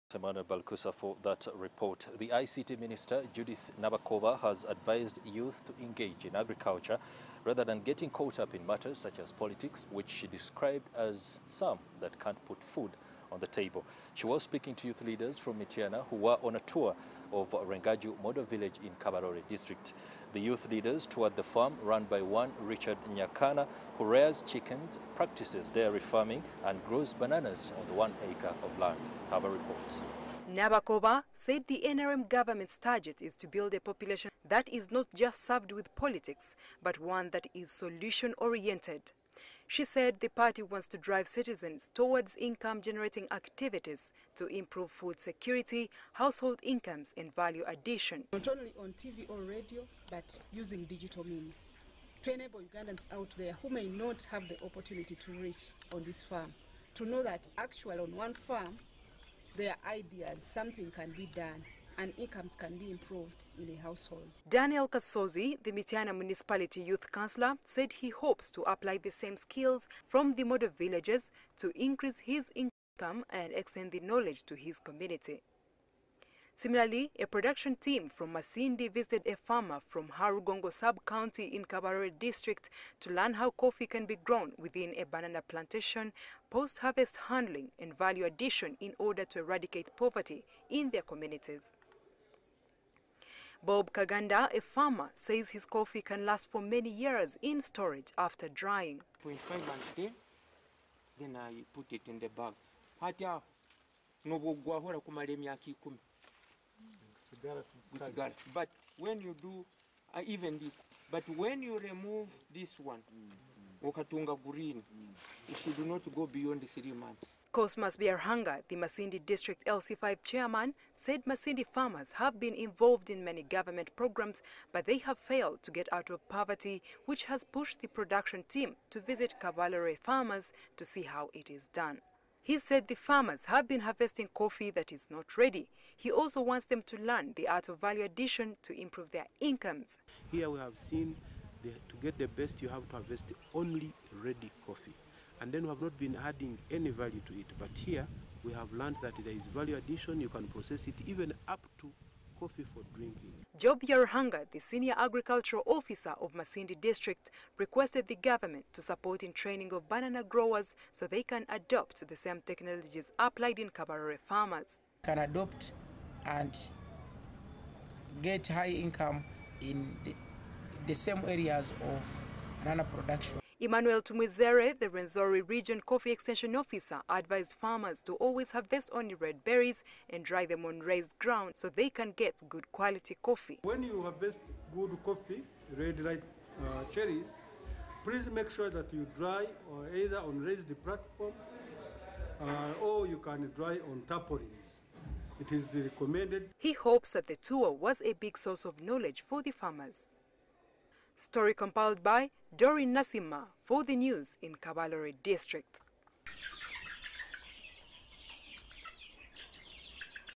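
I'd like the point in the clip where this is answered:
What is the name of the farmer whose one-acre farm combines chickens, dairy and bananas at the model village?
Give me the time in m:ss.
0:22.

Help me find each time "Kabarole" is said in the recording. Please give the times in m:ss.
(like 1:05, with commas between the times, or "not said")
0:18, 1:21, 2:09, 2:43, 3:24.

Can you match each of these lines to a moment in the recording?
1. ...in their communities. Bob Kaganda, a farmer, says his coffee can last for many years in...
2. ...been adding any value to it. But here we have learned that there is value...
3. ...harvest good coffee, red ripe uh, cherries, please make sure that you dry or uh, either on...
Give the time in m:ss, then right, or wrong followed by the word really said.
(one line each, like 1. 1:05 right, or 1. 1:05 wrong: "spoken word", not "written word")
1. 1:30 right
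2. 2:25 right
3. 3:04 right.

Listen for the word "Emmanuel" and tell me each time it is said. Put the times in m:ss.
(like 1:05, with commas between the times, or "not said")
0:00, 2:53.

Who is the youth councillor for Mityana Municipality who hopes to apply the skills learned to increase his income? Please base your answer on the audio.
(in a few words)
Daniel Kasozi.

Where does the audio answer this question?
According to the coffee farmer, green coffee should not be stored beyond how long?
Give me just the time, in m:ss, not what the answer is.
1:56.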